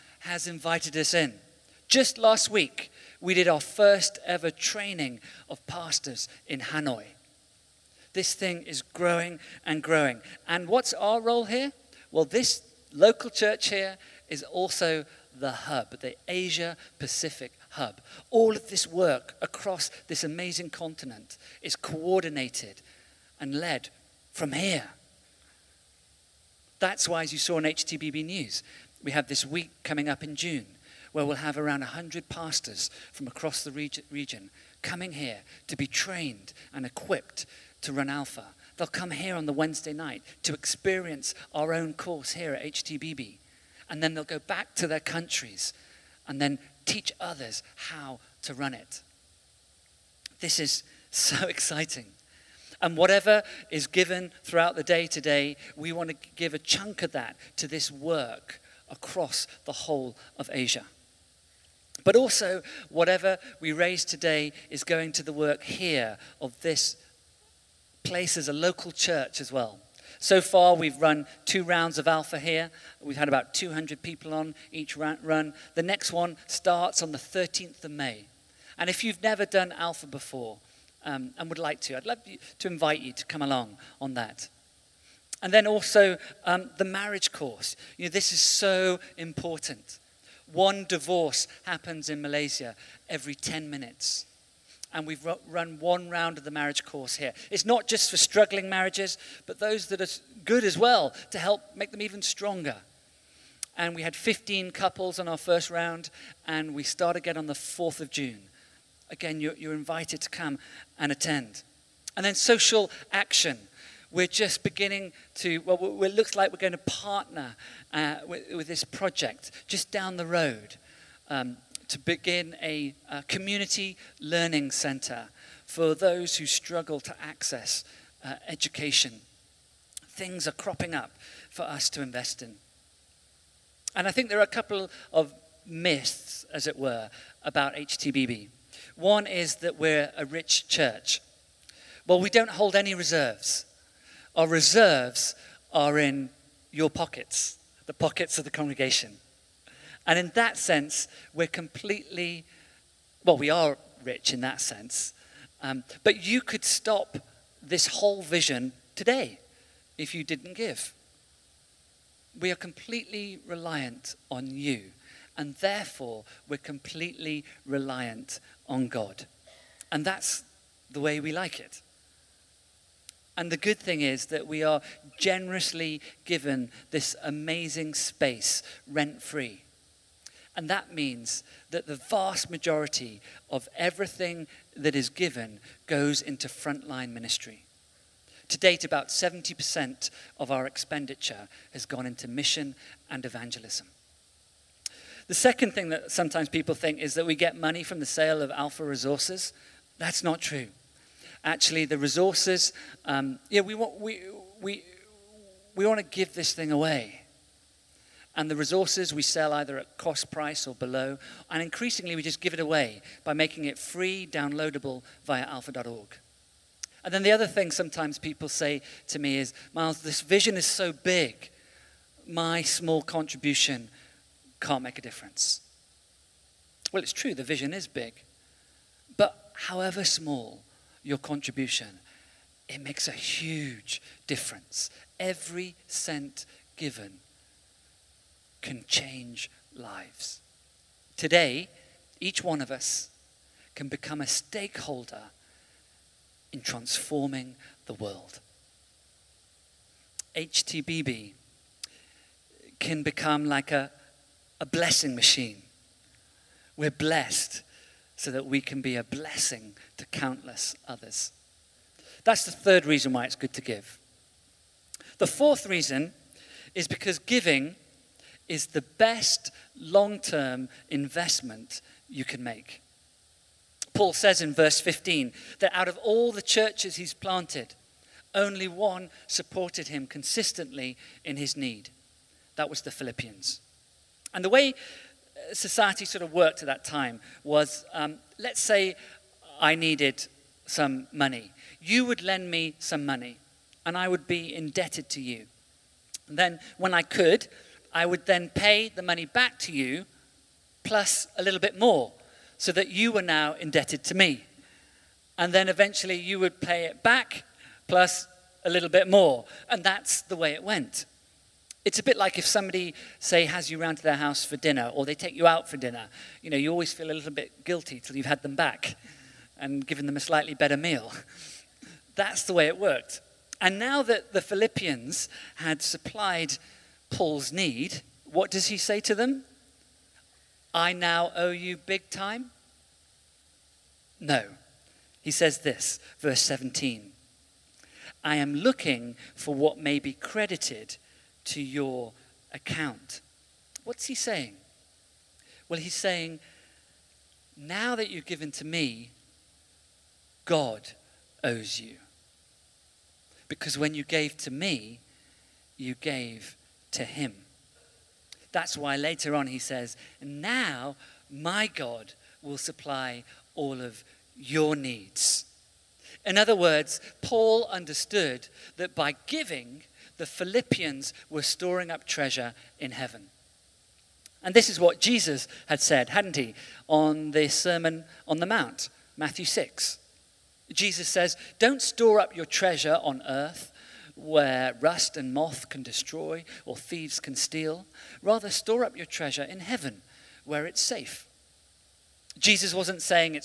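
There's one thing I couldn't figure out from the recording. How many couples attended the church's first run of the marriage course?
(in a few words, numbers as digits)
15.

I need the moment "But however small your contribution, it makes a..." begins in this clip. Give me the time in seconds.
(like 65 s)
229 s.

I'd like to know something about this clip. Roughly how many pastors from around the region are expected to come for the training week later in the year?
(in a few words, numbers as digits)
100.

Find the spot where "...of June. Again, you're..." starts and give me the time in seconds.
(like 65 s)
108 s.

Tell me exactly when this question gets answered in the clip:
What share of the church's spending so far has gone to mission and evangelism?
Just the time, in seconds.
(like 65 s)
189 s.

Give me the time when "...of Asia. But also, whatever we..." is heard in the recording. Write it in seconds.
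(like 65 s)
60 s.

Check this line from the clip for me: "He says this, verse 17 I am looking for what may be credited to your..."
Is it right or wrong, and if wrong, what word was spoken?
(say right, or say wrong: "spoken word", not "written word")
right.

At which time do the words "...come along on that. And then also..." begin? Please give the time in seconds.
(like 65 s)
83 s.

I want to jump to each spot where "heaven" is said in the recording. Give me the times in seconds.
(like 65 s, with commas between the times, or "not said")
372 s, 389 s.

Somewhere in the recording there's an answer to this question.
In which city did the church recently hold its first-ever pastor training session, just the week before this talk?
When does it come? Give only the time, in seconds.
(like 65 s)
6 s.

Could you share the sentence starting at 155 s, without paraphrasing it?
Um, but you could stop this whole vision today if you didn't give.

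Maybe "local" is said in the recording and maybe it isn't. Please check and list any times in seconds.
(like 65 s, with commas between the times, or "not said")
12 s, 68 s.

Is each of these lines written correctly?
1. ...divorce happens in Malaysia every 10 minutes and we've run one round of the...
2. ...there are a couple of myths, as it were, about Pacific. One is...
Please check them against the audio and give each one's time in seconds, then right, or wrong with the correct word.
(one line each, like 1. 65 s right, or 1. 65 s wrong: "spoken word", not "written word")
1. 90 s right
2. 134 s wrong: "HTBB", not "Pacific".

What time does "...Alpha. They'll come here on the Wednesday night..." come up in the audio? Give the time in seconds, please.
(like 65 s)
38 s.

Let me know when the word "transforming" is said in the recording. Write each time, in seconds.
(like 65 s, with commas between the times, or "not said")
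246 s.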